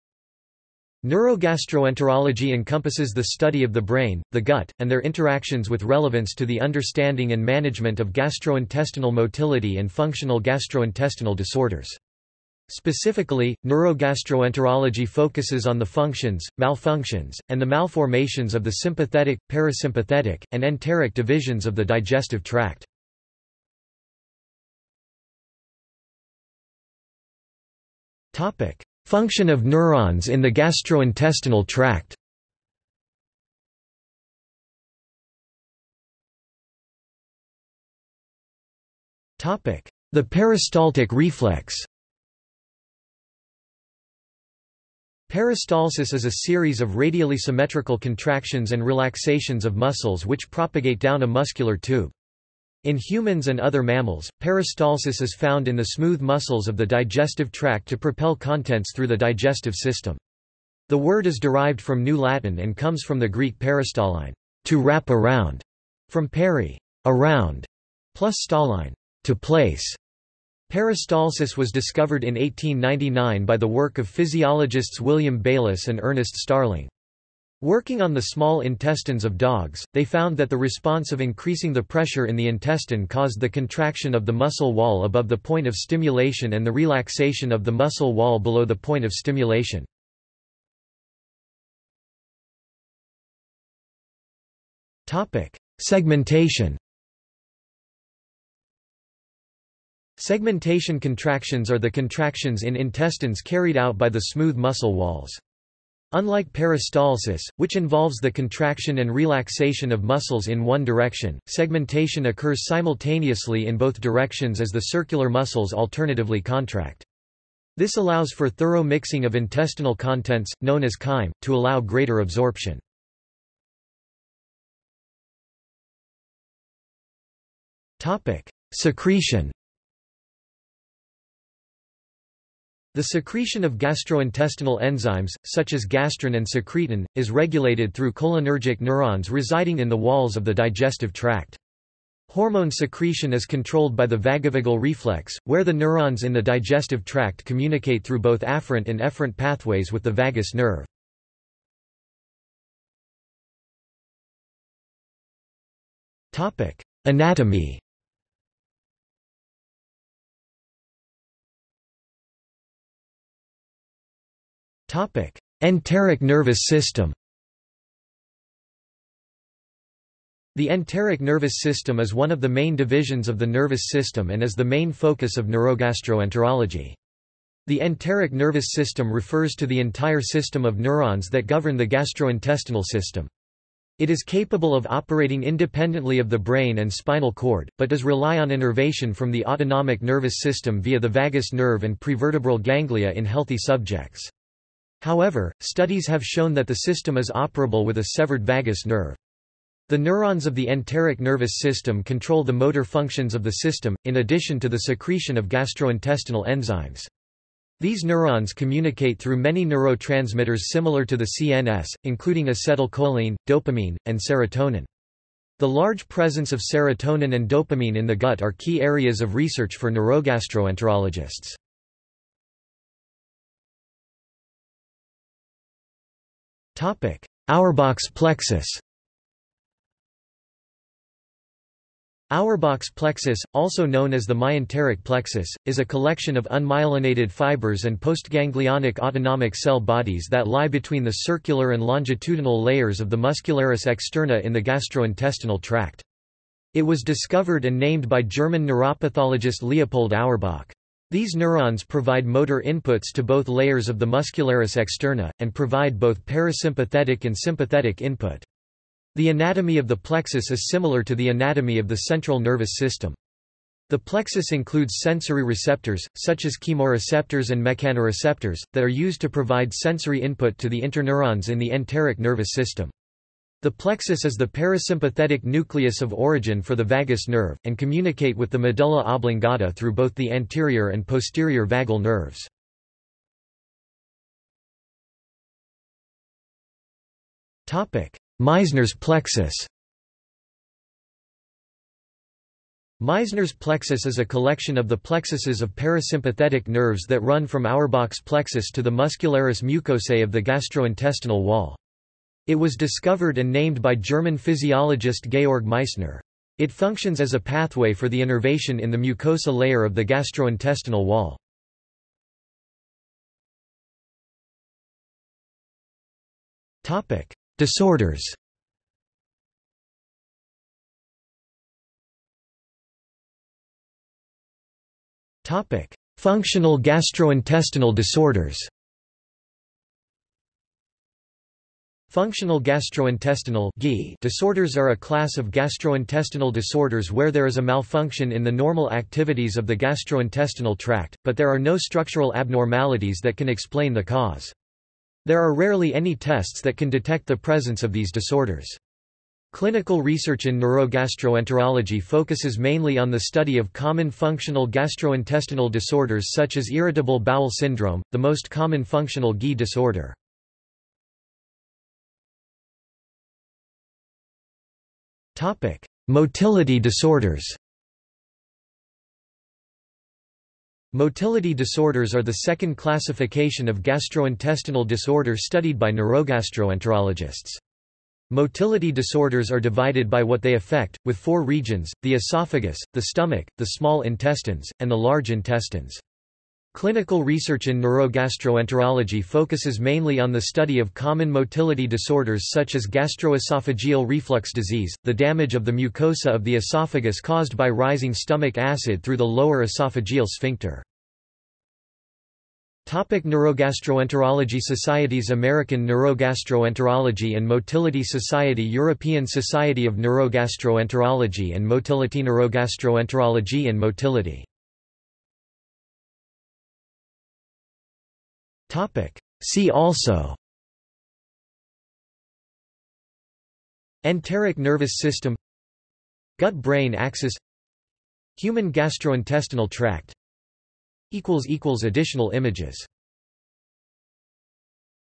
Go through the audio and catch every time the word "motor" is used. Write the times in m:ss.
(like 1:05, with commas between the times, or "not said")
3:22, 4:12.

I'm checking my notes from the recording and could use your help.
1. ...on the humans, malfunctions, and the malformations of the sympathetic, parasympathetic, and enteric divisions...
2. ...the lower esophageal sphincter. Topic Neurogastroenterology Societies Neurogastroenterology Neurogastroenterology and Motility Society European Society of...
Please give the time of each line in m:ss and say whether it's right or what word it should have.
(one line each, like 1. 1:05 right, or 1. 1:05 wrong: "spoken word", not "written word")
1. 0:15 wrong: "functions", not "humans"
2. 6:39 wrong: "American", not "Neurogastroenterology".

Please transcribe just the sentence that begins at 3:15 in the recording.
However, studies have shown that the system is operable with a severed vagus nerve.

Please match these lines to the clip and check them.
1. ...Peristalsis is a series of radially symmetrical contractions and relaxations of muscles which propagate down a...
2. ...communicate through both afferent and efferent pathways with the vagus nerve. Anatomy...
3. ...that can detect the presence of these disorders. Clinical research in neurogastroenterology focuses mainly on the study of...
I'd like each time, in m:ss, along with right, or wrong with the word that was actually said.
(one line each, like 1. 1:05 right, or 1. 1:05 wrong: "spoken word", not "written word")
1. 0:45 right
2. 2:27 right
3. 5:46 right.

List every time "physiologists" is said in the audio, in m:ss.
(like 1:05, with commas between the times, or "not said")
1:14, 5:04.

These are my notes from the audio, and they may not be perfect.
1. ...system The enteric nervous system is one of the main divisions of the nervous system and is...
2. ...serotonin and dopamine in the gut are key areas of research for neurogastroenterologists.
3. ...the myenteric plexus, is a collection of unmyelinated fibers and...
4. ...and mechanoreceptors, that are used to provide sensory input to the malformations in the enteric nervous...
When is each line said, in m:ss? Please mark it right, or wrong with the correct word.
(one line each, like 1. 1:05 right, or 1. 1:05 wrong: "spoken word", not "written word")
1. 2:46 right
2. 3:36 right
3. 3:54 right
4. 4:27 wrong: "interneurons", not "malformations".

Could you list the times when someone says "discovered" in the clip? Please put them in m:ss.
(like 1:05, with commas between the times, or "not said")
1:11, 4:07, 5:02.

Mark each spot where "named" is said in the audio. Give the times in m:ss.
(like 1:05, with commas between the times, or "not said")
4:07, 5:03.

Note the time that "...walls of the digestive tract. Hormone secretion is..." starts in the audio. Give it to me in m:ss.
2:19.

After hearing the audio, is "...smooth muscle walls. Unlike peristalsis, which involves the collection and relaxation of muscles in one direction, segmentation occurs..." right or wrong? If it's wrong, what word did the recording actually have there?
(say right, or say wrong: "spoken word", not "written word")
wrong: "contraction", not "collection".